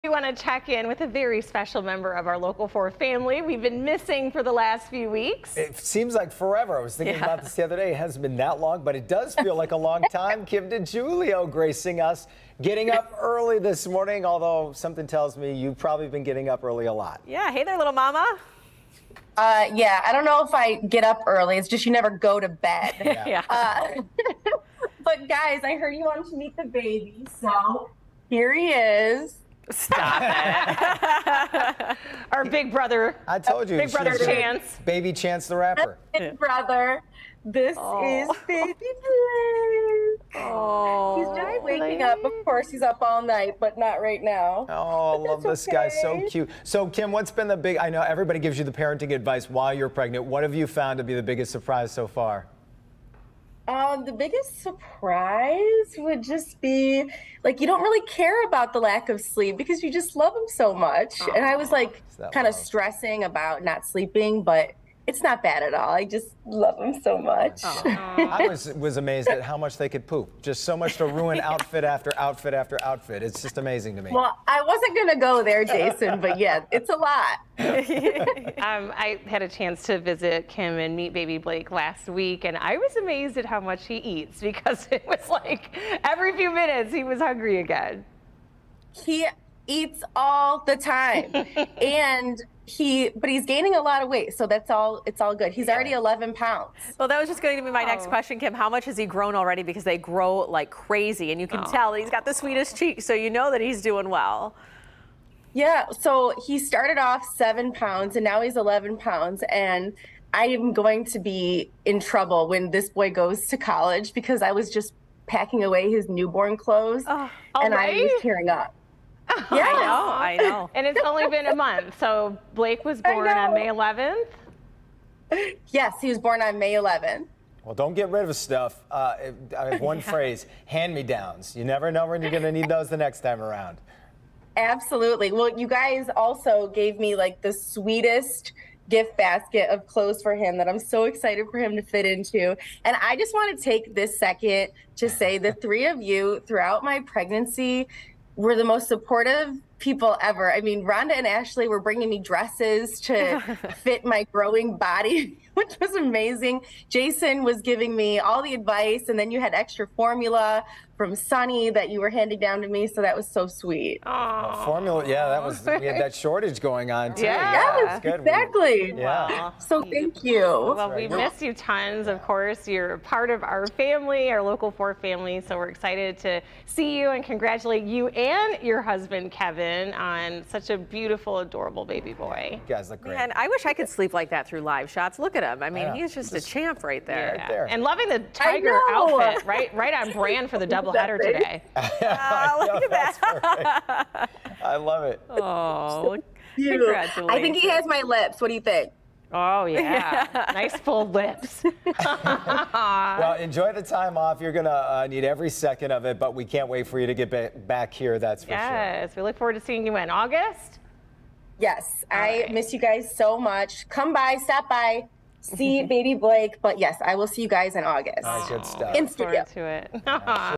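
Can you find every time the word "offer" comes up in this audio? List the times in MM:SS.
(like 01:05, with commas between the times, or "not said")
not said.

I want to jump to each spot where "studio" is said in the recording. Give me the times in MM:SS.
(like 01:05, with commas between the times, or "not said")
03:39.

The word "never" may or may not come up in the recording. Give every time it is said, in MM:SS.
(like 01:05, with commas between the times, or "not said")
00:21, 02:11.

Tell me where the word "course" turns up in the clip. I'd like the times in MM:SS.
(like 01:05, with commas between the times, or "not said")
00:42, 02:52.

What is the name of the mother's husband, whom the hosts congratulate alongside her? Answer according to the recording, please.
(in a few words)
Kevin.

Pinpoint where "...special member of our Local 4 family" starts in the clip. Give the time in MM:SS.
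00:01.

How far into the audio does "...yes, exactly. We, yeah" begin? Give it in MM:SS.
02:48.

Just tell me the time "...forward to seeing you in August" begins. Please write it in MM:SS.
03:29.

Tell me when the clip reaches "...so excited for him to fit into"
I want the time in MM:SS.
02:20.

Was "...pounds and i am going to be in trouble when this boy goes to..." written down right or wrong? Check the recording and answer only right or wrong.
right.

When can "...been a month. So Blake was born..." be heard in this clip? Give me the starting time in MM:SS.
02:01.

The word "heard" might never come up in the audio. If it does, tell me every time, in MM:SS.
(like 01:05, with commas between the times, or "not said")
00:25.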